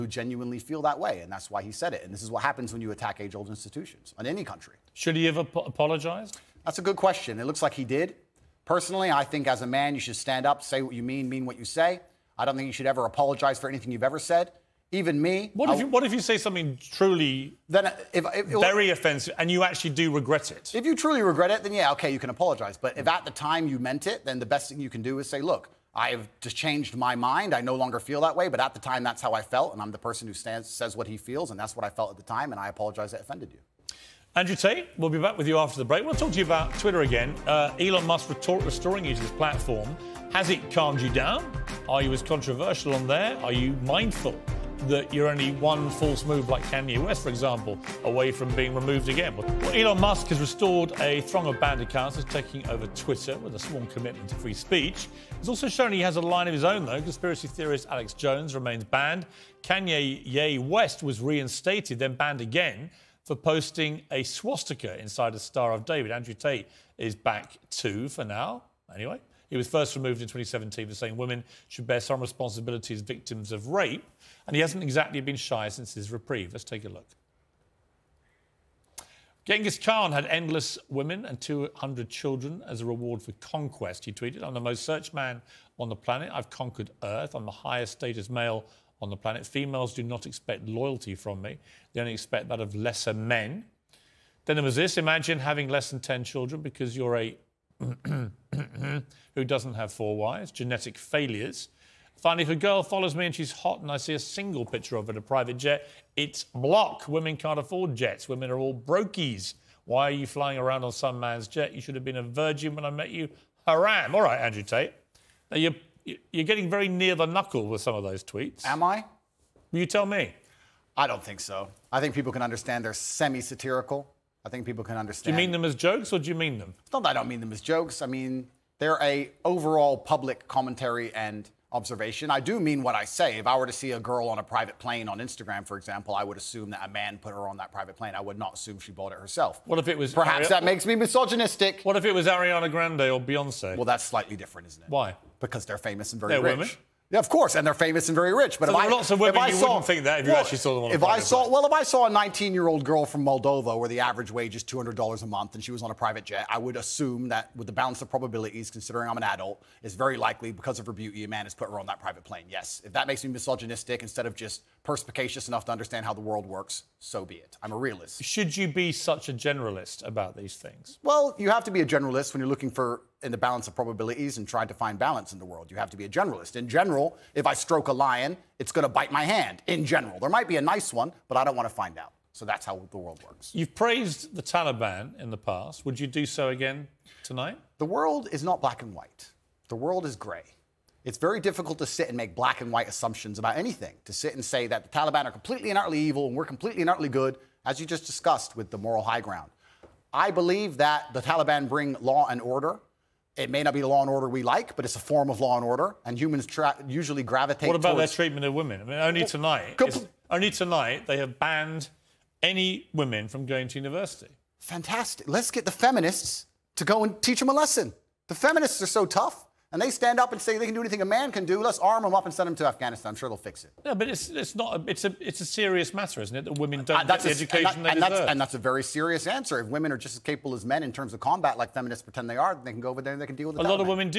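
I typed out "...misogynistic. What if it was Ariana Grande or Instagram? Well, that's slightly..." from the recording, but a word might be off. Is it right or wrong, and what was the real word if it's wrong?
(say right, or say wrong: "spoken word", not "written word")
wrong: "Beyonce", not "Instagram".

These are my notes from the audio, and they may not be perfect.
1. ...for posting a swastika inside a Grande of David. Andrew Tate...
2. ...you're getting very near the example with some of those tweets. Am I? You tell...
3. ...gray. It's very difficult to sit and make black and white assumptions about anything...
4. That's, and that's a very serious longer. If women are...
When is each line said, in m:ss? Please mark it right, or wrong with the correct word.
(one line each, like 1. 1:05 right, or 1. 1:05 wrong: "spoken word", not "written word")
1. 1:03 wrong: "Star", not "Grande"
2. 1:56 wrong: "knuckle", not "example"
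3. 3:10 right
4. 3:48 wrong: "answer", not "longer".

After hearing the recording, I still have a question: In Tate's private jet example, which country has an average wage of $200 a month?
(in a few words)
Moldova.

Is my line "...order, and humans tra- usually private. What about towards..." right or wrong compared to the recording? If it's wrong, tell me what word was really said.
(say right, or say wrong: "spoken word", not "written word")
wrong: "gravitate", not "private".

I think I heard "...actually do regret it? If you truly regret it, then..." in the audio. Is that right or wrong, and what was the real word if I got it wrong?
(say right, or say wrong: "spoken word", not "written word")
right.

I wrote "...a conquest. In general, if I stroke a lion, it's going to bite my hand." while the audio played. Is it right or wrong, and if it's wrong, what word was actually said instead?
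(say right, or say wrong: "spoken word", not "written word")
wrong: "generalist", not "conquest".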